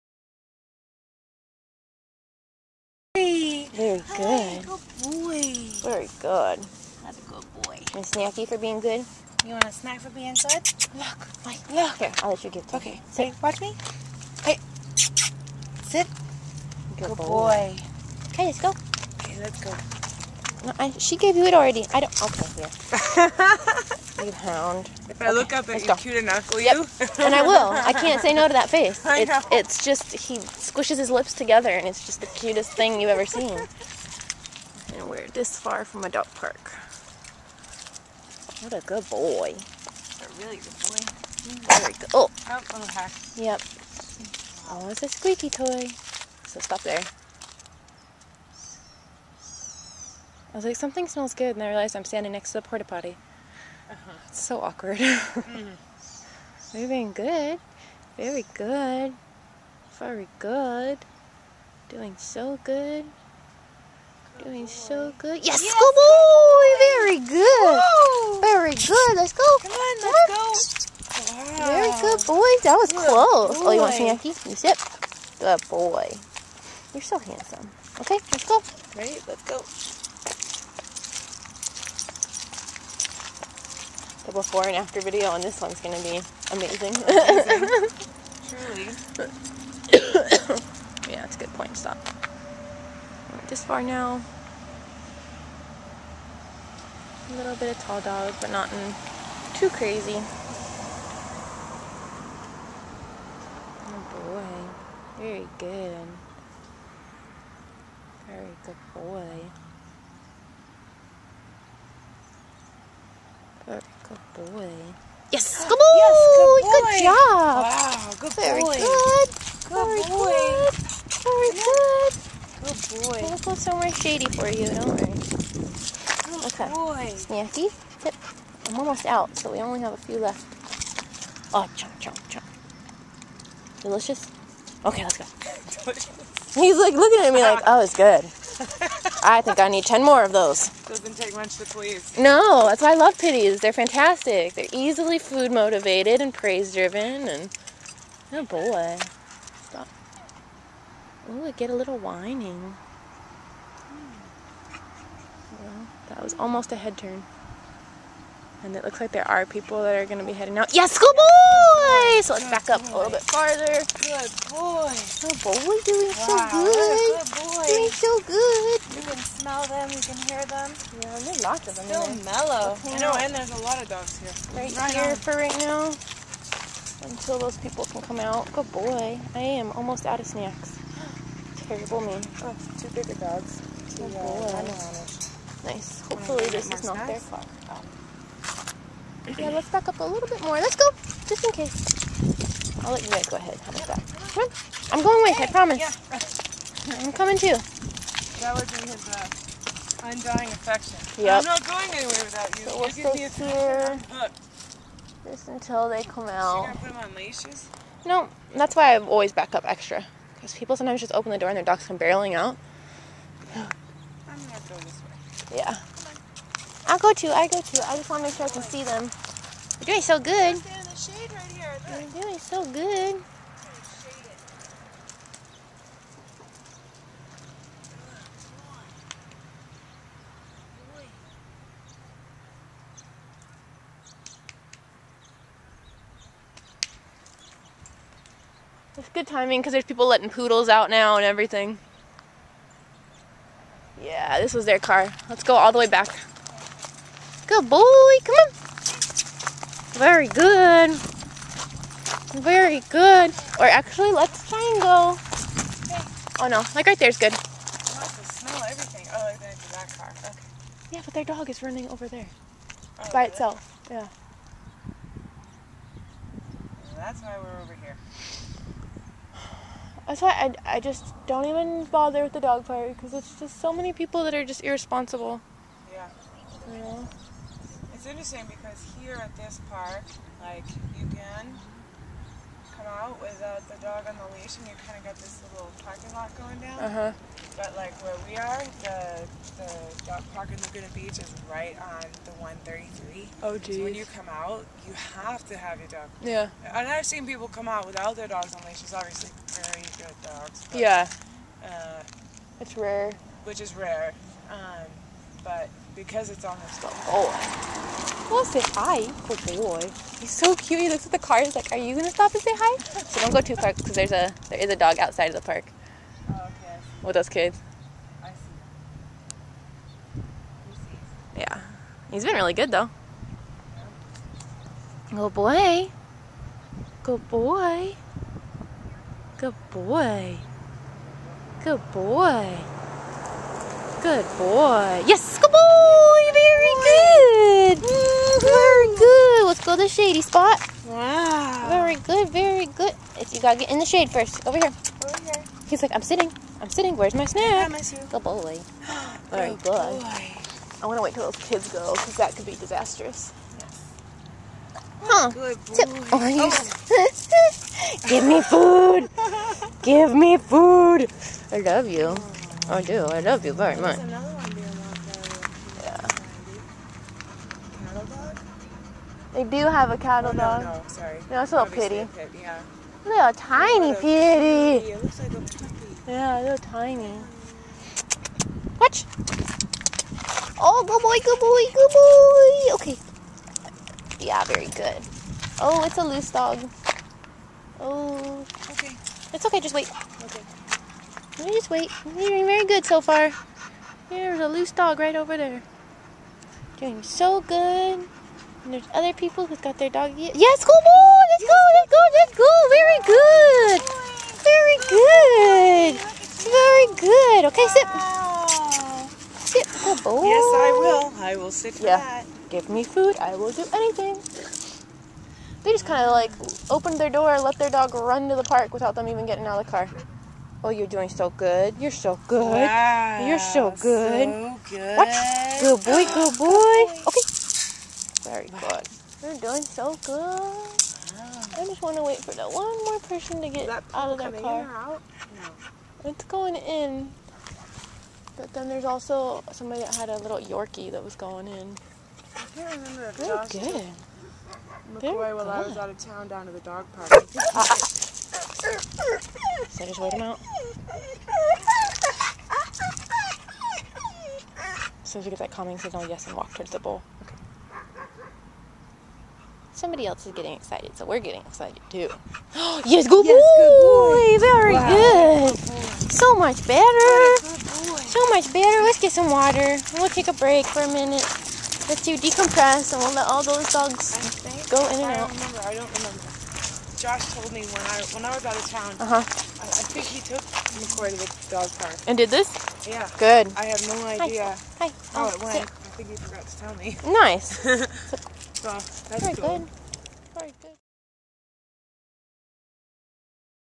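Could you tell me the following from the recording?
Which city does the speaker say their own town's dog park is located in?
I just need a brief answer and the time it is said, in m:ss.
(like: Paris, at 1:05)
Laguna Beach, at 4:50.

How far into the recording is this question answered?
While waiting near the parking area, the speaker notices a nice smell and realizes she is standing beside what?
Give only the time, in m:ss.
0:52.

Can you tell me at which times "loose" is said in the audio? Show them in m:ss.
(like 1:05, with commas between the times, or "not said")
6:26, 6:34.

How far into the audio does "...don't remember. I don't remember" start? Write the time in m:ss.
7:55.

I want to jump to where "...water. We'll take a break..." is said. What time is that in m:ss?
7:49.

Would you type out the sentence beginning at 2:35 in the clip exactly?
Well, that was almost a head turn.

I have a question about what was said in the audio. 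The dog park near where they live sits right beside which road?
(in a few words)
The 133.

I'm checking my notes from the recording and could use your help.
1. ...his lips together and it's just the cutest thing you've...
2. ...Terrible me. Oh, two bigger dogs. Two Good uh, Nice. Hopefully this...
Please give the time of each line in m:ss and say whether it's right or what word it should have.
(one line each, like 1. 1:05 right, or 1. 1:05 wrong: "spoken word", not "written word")
1. 0:30 right
2. 3:01 right.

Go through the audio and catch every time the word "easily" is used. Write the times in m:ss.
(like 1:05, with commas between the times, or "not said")
2:24.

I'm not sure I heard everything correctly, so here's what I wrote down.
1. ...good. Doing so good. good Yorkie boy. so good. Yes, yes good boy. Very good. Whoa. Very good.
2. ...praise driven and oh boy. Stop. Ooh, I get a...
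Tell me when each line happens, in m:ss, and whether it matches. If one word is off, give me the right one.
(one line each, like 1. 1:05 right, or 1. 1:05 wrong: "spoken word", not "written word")
1. 1:00 wrong: "Doing", not "Yorkie"
2. 2:26 right.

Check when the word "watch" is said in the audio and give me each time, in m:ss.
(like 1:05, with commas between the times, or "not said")
0:13, 6:18, 7:04.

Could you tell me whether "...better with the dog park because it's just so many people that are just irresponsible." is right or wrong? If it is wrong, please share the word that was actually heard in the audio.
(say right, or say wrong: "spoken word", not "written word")
wrong: "bother", not "better".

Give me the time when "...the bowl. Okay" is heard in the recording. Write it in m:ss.
7:36.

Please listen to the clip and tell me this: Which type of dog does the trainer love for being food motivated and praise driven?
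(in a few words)
Pitties.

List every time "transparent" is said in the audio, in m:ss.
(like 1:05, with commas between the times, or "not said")
not said.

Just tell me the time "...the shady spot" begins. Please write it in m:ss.
5:39.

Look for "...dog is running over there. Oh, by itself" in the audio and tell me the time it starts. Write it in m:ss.
4:21.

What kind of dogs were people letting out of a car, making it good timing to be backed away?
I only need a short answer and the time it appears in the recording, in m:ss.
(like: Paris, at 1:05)
Poodles, at 4:00.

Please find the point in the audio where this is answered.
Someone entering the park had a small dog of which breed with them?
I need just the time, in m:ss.
7:20.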